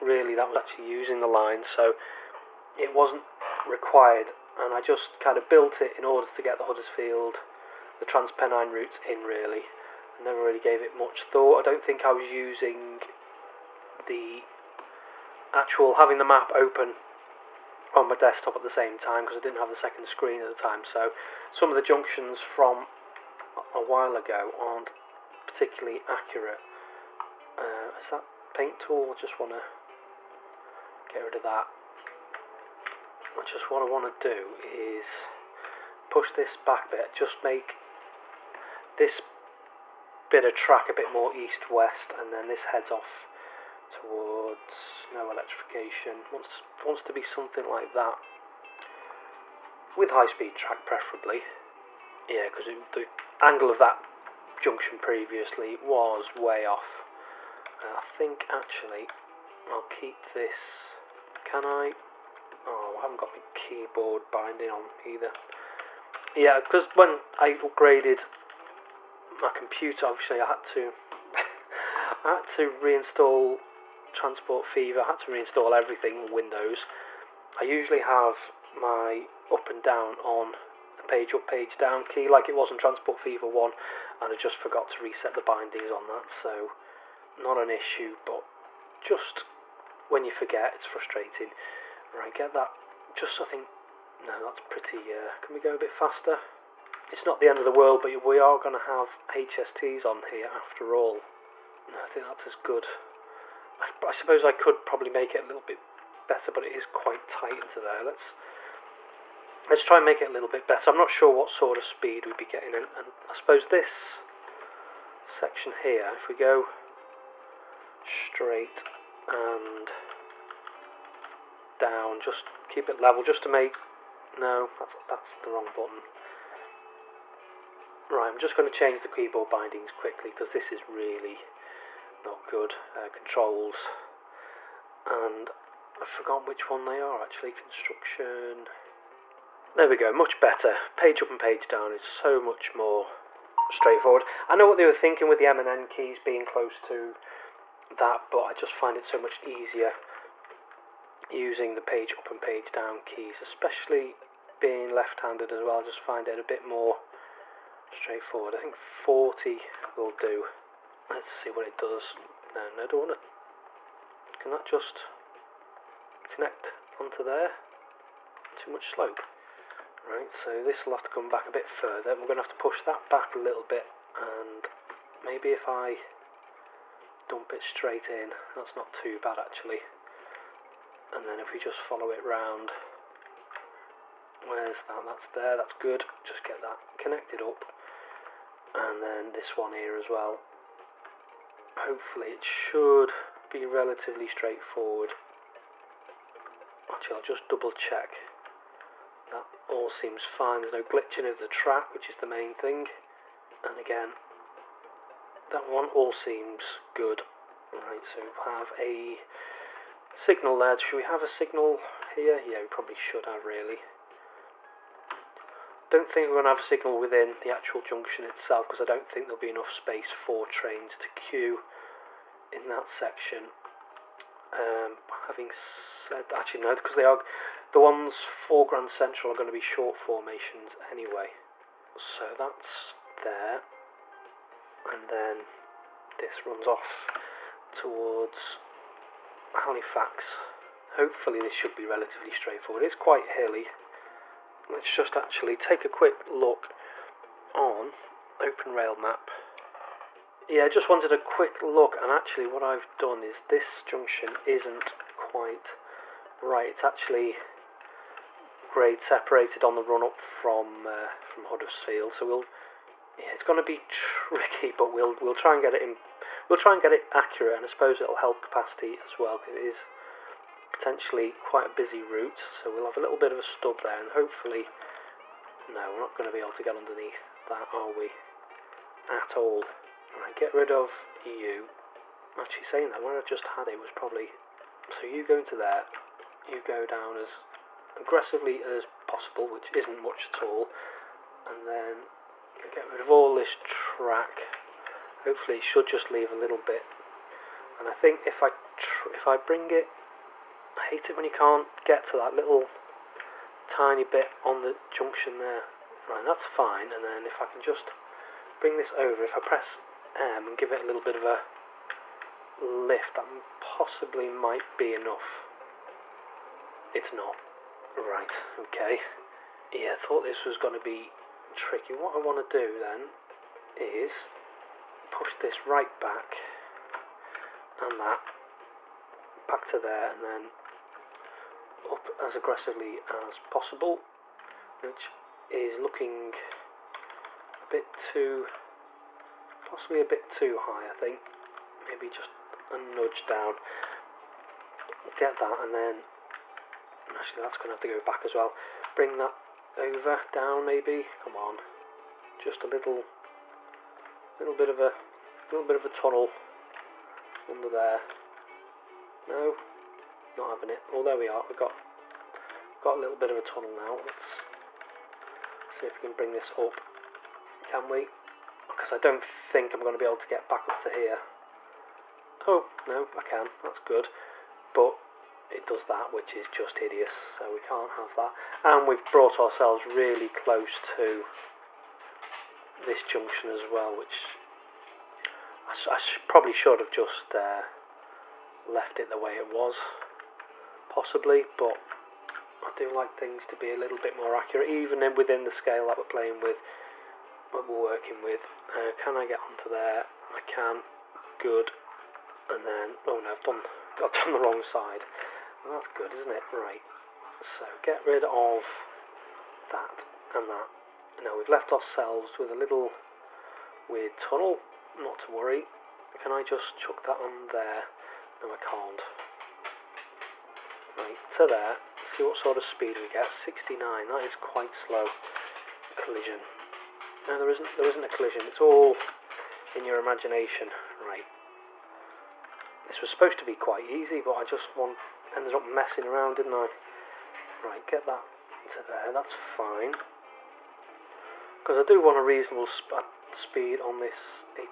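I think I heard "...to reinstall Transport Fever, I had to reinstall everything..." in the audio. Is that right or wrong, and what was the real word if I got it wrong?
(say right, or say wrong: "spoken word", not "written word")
right.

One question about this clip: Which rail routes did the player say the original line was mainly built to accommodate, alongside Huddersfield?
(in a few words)
Transpennine routes.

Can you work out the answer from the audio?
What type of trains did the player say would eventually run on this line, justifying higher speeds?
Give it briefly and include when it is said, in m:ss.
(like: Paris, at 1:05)
HSTs, at 1:39.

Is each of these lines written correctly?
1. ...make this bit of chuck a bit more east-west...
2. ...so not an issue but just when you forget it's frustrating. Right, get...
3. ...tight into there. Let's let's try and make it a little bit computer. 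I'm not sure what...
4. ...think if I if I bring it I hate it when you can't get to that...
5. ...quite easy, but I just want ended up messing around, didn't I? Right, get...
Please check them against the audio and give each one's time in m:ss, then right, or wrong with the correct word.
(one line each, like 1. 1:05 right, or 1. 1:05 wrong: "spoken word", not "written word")
1. 0:37 wrong: "track", not "chuck"
2. 1:26 right
3. 1:47 wrong: "better", not "computer"
4. 4:57 right
5. 7:13 right.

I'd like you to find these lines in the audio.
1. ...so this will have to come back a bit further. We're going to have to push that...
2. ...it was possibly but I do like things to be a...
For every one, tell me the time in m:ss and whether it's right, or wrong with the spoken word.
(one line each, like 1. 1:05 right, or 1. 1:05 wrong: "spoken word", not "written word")
1. 2:50 right
2. 6:29 right.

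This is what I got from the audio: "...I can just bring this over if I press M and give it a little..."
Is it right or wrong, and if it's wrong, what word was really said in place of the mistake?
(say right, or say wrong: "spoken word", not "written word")
right.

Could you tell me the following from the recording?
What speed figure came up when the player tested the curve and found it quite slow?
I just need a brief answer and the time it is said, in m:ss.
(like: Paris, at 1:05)
69, at 7:03.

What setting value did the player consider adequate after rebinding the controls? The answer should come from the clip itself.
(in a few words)
40.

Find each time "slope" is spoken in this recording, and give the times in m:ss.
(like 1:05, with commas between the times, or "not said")
2:48.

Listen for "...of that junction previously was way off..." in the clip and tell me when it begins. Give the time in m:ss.
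0:53.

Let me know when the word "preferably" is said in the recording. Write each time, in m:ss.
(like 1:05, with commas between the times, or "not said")
0:50.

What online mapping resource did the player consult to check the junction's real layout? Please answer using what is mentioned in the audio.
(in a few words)
Open Rail Map.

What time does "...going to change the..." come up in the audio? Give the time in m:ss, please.
2:08.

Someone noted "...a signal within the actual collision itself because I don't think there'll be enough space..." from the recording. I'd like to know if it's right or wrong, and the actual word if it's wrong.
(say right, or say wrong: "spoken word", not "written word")
wrong: "junction", not "collision".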